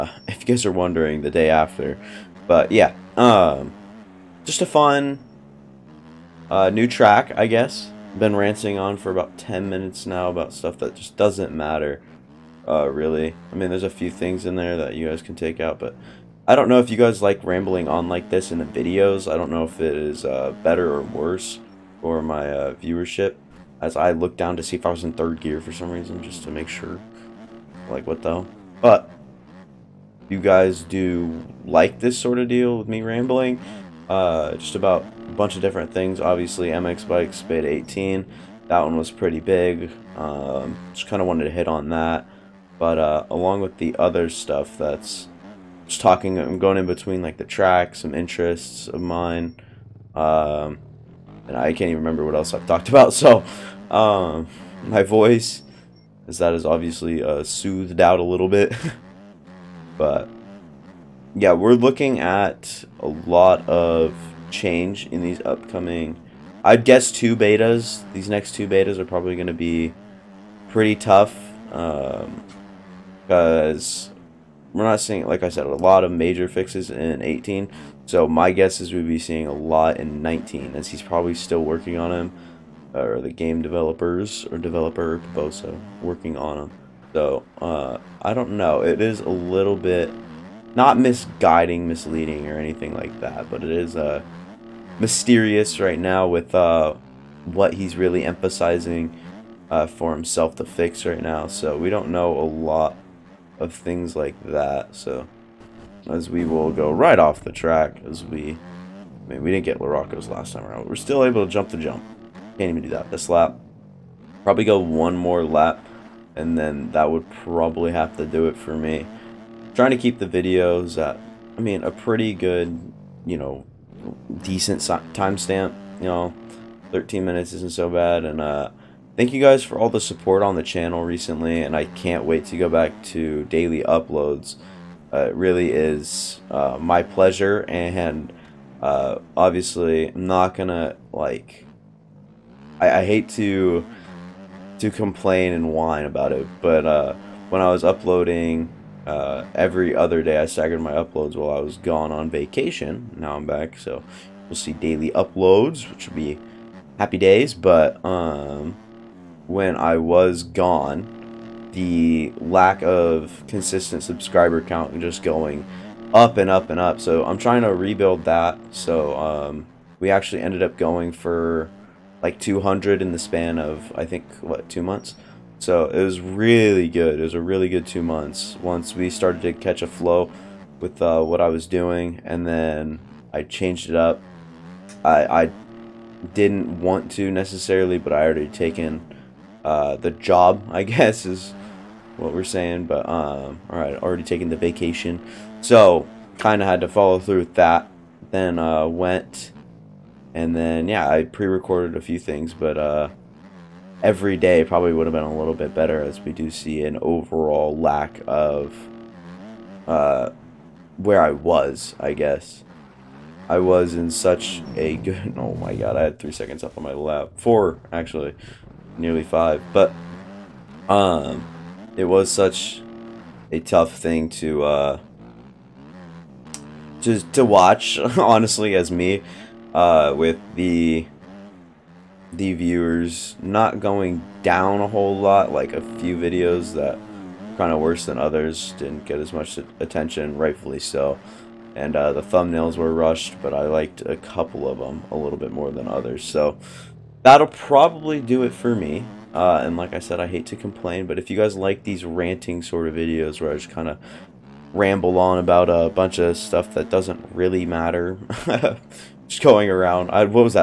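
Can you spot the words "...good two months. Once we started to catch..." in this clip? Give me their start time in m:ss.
2:57.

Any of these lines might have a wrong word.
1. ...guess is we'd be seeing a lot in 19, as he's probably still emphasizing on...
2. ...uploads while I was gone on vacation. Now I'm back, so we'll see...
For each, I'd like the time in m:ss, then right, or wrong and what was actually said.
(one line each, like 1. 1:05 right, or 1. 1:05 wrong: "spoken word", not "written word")
1. 1:18 wrong: "working", not "emphasizing"
2. 2:30 right.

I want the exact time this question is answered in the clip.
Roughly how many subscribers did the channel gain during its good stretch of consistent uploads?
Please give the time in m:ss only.
2:52.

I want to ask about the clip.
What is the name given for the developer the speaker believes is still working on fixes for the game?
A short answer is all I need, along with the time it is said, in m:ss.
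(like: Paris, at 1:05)
Bosa, at 1:25.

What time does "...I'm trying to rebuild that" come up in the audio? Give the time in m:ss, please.
2:47.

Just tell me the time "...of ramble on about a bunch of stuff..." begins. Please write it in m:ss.
4:13.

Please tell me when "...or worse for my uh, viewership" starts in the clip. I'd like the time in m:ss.
0:20.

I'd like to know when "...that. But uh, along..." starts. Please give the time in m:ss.
0:41.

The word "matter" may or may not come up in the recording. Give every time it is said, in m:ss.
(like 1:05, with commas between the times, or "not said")
0:11, 4:17.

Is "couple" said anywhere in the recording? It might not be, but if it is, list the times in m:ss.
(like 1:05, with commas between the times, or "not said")
4:04.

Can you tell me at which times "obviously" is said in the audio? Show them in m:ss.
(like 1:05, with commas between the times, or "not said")
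0:36, 0:56, 2:19.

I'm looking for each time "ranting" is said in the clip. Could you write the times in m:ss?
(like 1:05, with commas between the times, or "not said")
0:08, 4:12.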